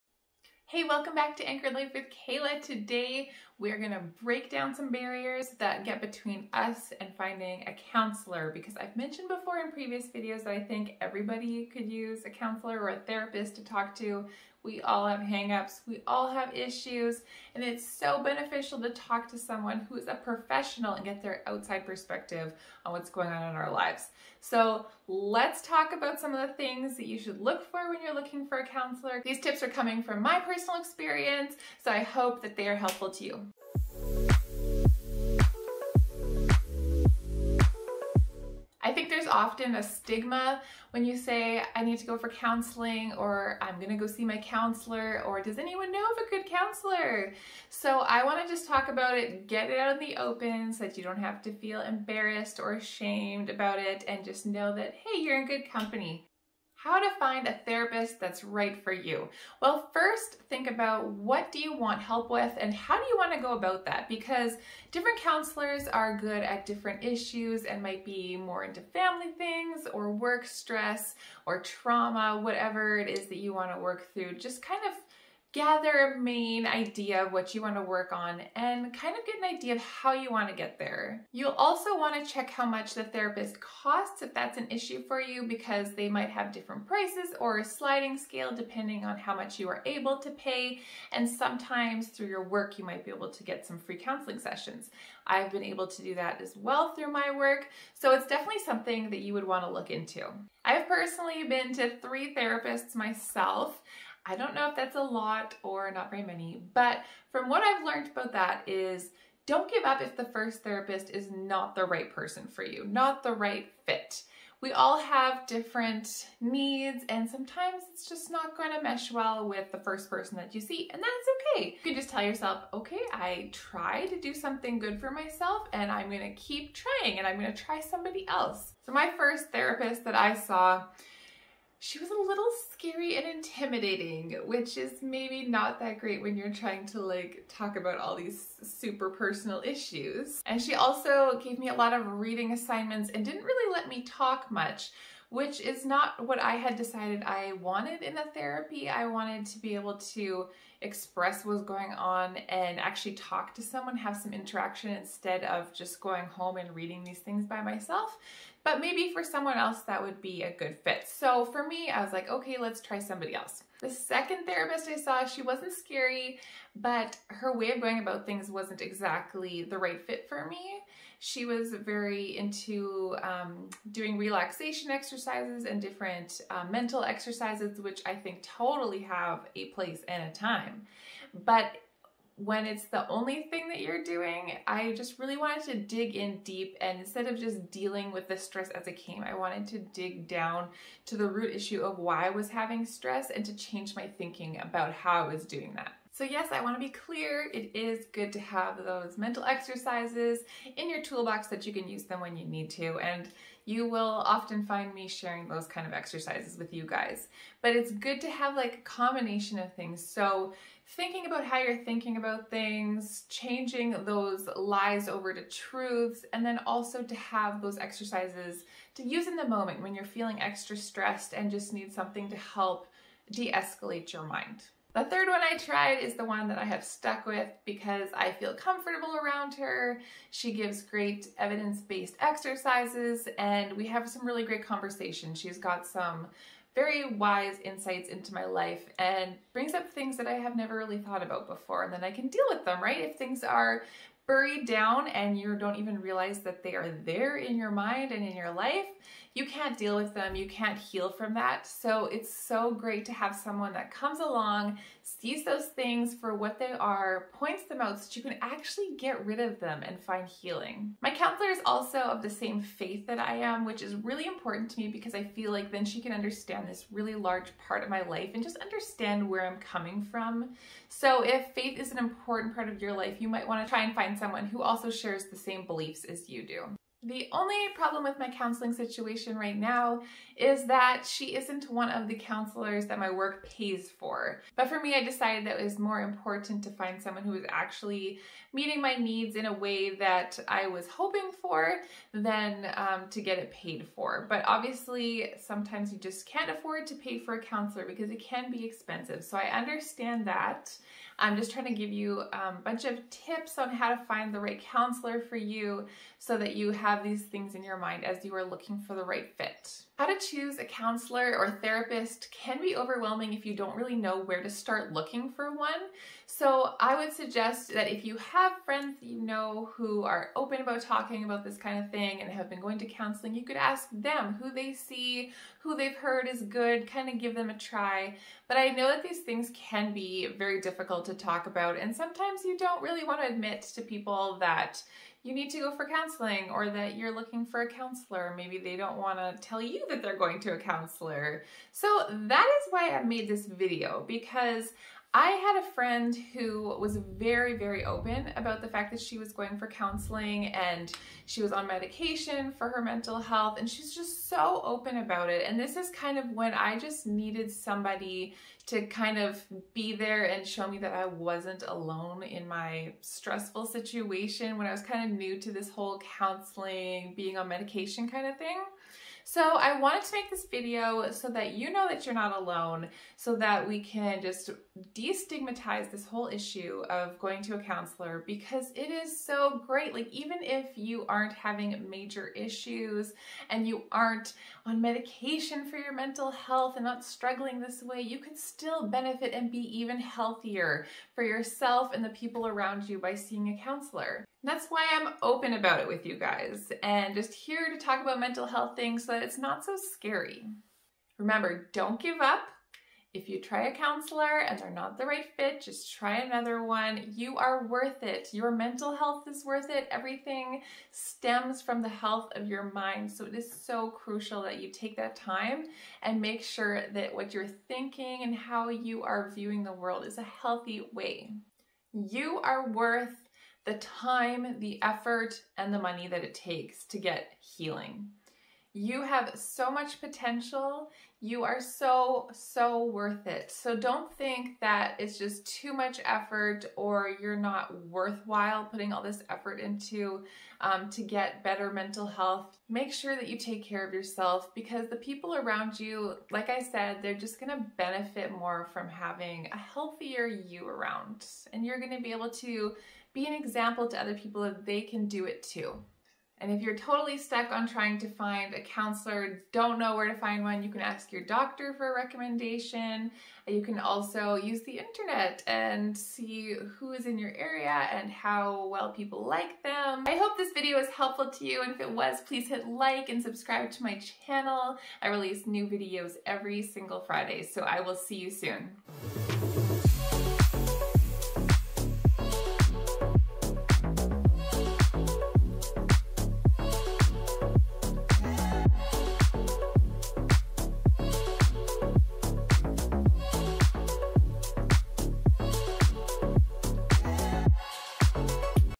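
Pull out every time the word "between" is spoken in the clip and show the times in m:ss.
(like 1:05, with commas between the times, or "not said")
0:05.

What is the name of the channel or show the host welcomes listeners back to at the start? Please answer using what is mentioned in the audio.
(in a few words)
Anchored Life with Kayla.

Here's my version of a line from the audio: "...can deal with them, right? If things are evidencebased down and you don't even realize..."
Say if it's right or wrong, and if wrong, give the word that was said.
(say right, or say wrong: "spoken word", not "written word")
wrong: "buried", not "evidencebased".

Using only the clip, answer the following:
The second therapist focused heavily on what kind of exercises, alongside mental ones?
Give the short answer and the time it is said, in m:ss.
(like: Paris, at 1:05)
relaxation exercises, at 2:54.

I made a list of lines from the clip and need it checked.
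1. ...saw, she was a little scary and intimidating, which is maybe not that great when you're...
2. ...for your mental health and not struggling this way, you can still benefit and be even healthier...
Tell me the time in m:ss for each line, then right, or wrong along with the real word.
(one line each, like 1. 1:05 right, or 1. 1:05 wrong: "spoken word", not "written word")
1. 2:10 right
2. 6:25 right.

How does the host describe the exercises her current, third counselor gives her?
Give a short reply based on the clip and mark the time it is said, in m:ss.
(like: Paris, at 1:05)
evidence-based, at 3:51.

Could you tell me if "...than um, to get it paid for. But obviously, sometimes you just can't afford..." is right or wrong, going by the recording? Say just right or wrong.
right.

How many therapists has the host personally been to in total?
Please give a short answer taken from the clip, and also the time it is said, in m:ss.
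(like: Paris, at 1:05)
3, at 1:41.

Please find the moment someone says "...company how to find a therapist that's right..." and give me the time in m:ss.
0:55.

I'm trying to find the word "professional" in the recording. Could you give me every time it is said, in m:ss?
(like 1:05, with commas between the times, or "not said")
0:20.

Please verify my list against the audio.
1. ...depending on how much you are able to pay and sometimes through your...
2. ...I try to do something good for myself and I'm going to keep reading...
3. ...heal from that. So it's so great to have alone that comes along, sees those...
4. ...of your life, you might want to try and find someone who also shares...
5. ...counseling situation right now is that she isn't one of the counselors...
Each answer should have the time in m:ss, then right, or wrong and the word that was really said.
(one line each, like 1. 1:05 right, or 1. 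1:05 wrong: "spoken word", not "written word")
1. 1:28 right
2. 2:03 wrong: "trying", not "reading"
3. 4:10 wrong: "someone", not "alone"
4. 4:32 right
5. 4:38 right.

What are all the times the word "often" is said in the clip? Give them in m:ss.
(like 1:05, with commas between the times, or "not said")
0:39, 3:24.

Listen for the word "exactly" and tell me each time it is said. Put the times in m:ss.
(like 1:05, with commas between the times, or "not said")
2:48.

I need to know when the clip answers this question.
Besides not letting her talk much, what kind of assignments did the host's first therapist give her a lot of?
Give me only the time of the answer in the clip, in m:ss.
2:22.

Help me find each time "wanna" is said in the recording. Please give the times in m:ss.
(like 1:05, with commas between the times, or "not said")
0:48, 3:16.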